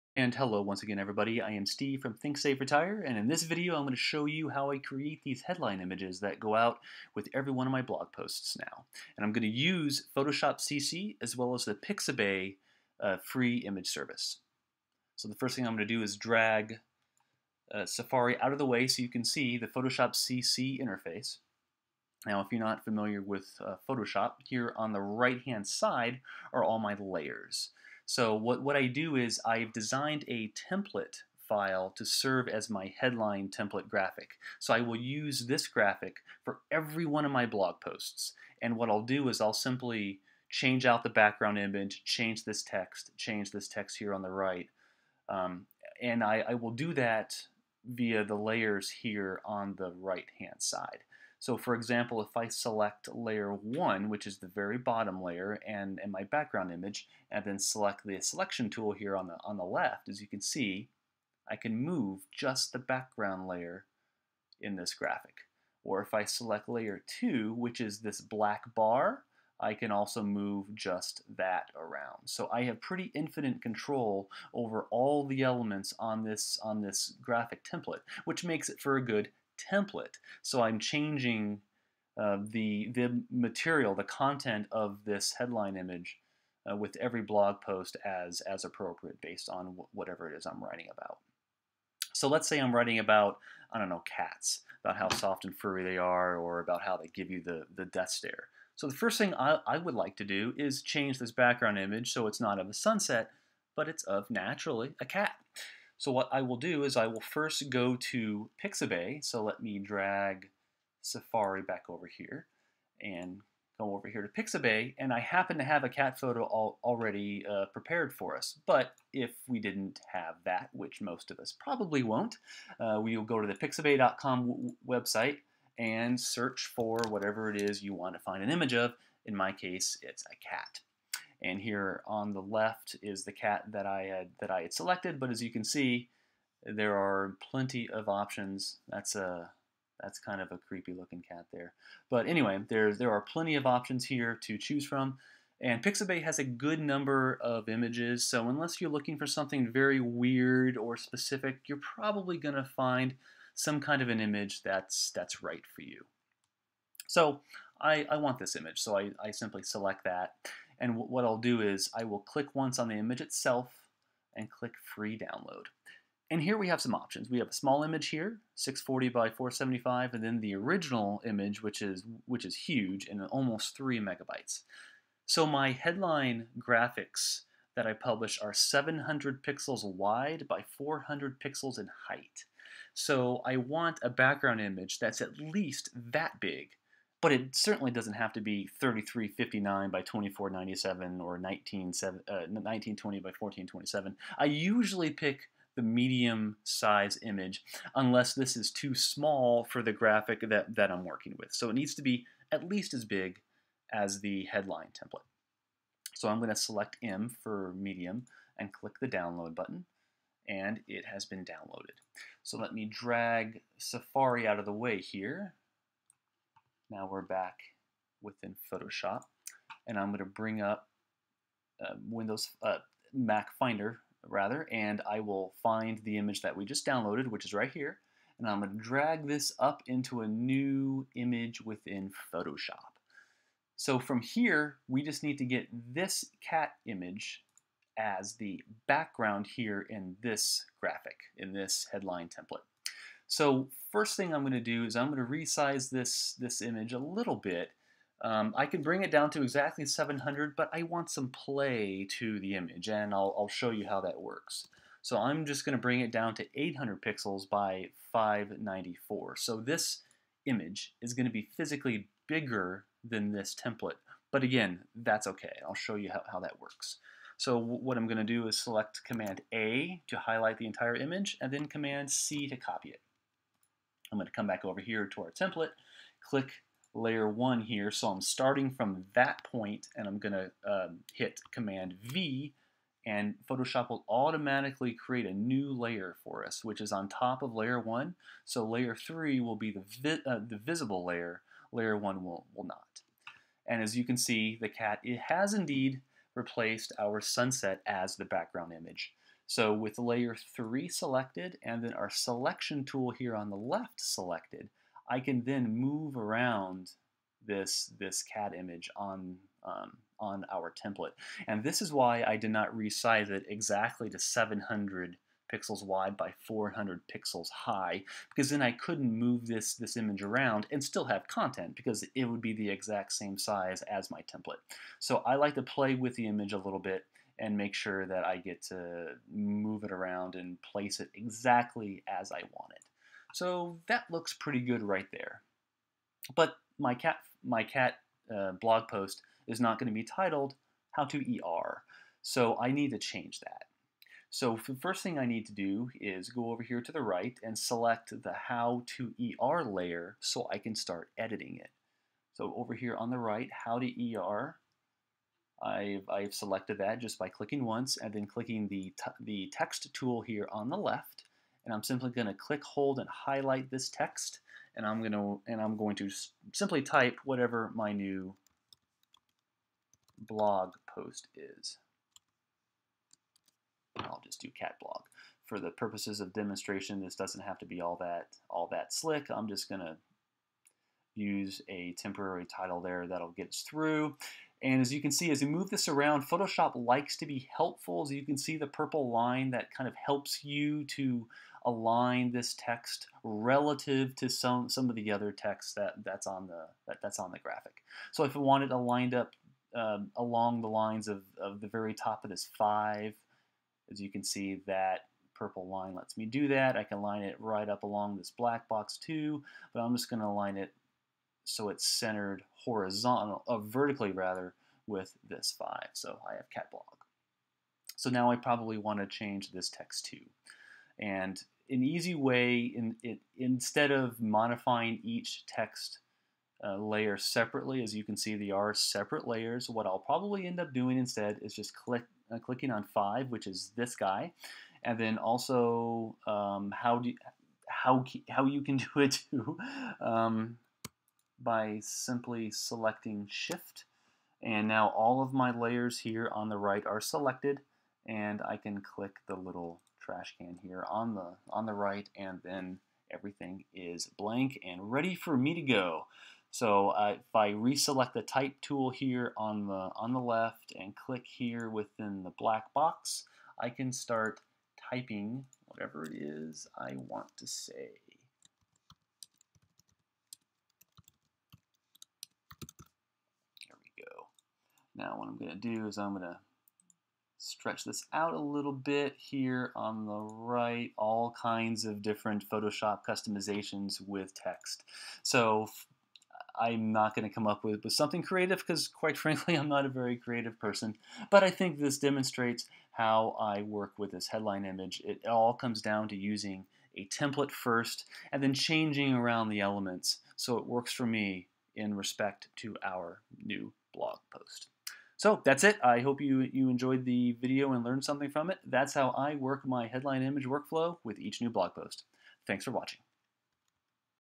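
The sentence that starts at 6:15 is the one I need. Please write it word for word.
For the purposes of demonstration, this doesn't have to be all that all that slick.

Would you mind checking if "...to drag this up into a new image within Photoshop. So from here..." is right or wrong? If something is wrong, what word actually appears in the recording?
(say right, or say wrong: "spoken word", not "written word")
right.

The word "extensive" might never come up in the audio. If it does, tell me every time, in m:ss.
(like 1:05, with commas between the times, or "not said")
not said.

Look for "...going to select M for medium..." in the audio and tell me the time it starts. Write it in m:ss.
3:26.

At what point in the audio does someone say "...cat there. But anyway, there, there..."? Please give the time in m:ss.
2:21.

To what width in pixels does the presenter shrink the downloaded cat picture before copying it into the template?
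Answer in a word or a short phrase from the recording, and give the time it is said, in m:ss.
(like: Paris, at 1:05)
800, at 4:16.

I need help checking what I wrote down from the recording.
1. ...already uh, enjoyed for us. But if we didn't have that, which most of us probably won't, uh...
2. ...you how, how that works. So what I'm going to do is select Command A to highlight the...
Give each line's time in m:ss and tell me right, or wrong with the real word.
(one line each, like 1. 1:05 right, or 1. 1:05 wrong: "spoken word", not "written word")
1. 1:56 wrong: "prepared", not "enjoyed"
2. 4:25 right.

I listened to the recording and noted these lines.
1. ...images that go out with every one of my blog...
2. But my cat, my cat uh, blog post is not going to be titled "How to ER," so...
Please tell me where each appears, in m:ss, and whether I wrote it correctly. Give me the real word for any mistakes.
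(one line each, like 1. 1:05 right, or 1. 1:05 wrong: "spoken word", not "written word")
1. 0:05 right
2. 5:36 right.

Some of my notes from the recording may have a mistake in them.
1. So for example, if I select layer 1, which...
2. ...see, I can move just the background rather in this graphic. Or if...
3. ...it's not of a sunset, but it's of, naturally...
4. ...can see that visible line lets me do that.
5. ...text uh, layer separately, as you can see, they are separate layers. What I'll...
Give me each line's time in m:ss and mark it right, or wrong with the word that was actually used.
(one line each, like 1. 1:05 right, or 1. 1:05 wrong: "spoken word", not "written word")
1. 0:51 right
2. 1:00 wrong: "layer", not "rather"
3. 1:42 right
4. 6:44 wrong: "purple", not "visible"
5. 7:05 right.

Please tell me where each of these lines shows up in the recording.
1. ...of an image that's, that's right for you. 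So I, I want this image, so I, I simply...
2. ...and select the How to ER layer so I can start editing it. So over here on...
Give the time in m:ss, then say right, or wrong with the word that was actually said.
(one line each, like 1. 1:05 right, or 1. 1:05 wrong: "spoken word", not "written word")
1. 2:34 right
2. 5:47 right.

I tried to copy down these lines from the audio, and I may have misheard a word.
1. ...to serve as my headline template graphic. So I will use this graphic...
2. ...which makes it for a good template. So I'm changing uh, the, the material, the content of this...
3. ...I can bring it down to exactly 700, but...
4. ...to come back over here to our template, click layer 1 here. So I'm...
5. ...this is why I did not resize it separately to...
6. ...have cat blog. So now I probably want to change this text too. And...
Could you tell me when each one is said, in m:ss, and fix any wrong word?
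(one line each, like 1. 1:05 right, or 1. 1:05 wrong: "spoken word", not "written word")
1. 0:31 right
2. 1:18 right
3. 4:08 right
4. 4:34 right
5. 5:11 wrong: "exactly", not "separately"
6. 6:56 right.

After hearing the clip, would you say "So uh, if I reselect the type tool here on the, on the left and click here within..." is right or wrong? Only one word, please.
right.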